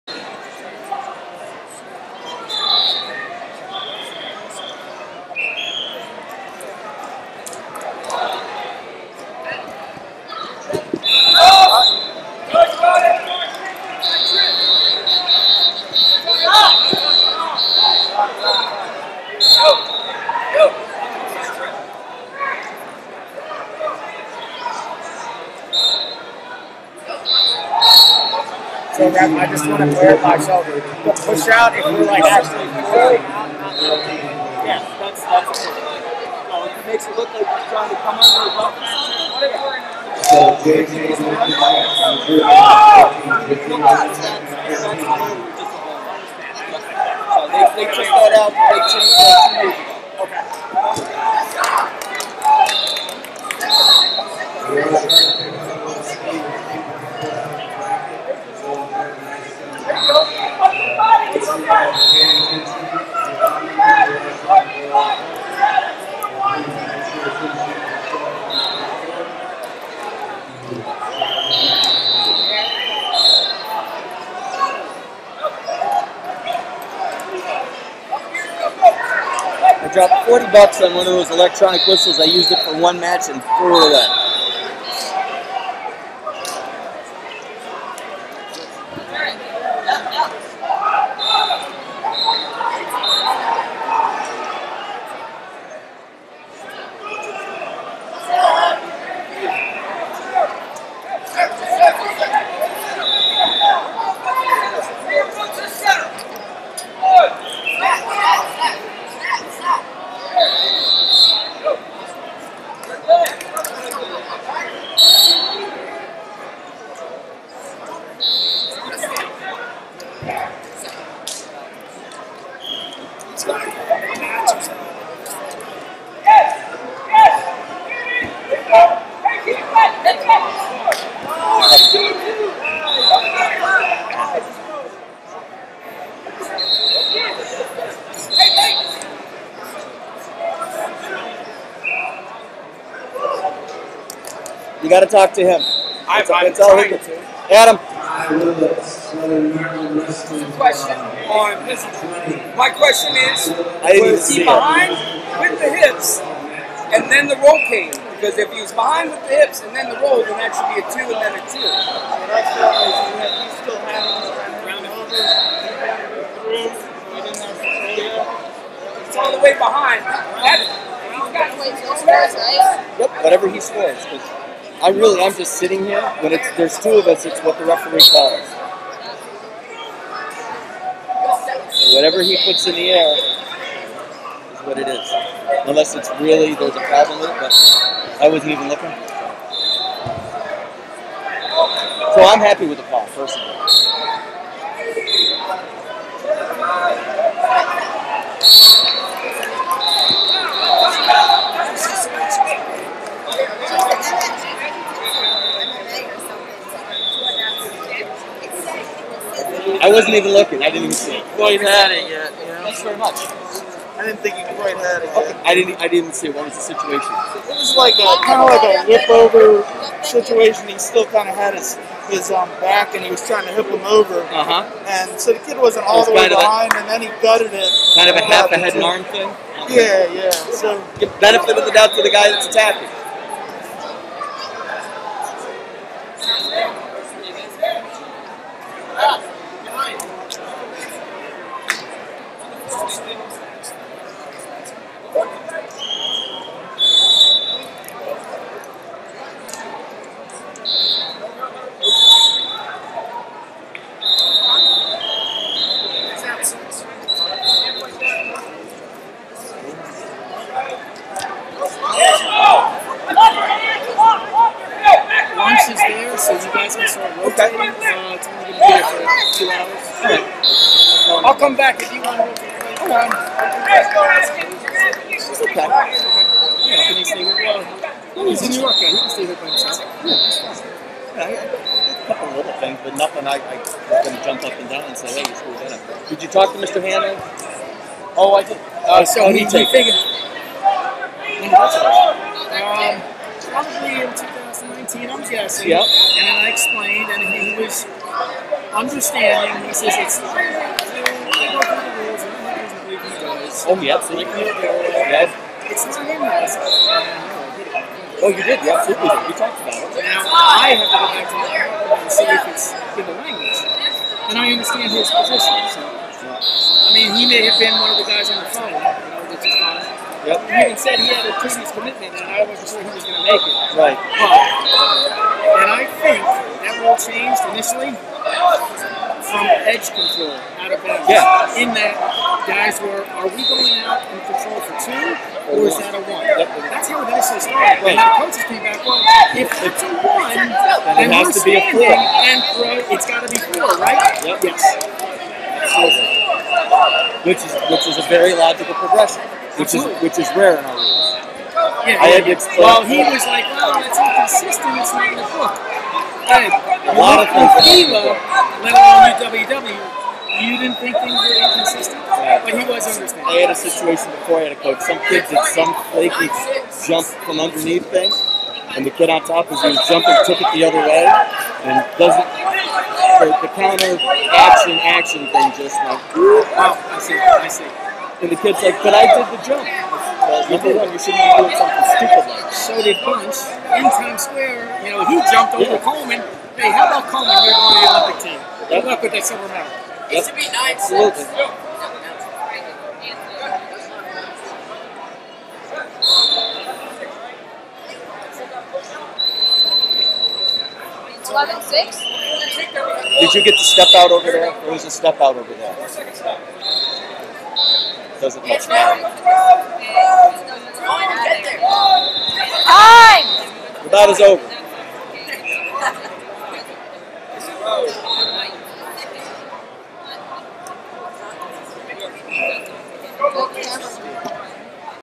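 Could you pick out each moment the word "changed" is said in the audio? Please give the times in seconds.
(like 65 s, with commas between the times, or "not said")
48 s, 327 s.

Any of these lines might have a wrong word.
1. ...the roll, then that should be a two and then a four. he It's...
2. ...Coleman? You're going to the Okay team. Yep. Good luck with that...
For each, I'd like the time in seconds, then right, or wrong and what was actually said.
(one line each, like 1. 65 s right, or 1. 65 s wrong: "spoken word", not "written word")
1. 159 s wrong: "two", not "four"
2. 387 s wrong: "Olympic", not "Okay".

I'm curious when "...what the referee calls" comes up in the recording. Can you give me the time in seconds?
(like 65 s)
177 s.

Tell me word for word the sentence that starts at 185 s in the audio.
Unless it's really there's a problem with it, but I wasn't even looking.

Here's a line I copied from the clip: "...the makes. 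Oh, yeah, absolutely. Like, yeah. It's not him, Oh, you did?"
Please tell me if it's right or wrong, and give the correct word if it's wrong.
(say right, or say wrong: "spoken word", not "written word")
wrong: "rules", not "makes".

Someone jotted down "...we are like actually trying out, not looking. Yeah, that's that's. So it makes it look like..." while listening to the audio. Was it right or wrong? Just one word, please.
wrong.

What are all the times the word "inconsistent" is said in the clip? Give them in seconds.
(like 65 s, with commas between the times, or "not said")
353 s, 361 s.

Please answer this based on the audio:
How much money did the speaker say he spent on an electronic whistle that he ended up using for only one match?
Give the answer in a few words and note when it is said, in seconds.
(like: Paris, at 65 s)
$40, at 80 s.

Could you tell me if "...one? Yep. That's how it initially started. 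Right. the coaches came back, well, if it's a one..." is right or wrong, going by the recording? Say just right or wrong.
right.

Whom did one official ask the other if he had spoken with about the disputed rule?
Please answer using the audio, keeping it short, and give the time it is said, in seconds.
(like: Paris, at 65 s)
Mr. Hannon, at 286 s.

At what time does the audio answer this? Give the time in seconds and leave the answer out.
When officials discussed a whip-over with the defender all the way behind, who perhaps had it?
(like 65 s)
211 s.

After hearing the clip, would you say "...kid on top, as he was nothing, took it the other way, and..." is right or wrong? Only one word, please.
wrong.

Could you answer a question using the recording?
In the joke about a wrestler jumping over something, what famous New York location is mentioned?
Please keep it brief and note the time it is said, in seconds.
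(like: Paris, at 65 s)
Times Square, at 383 s.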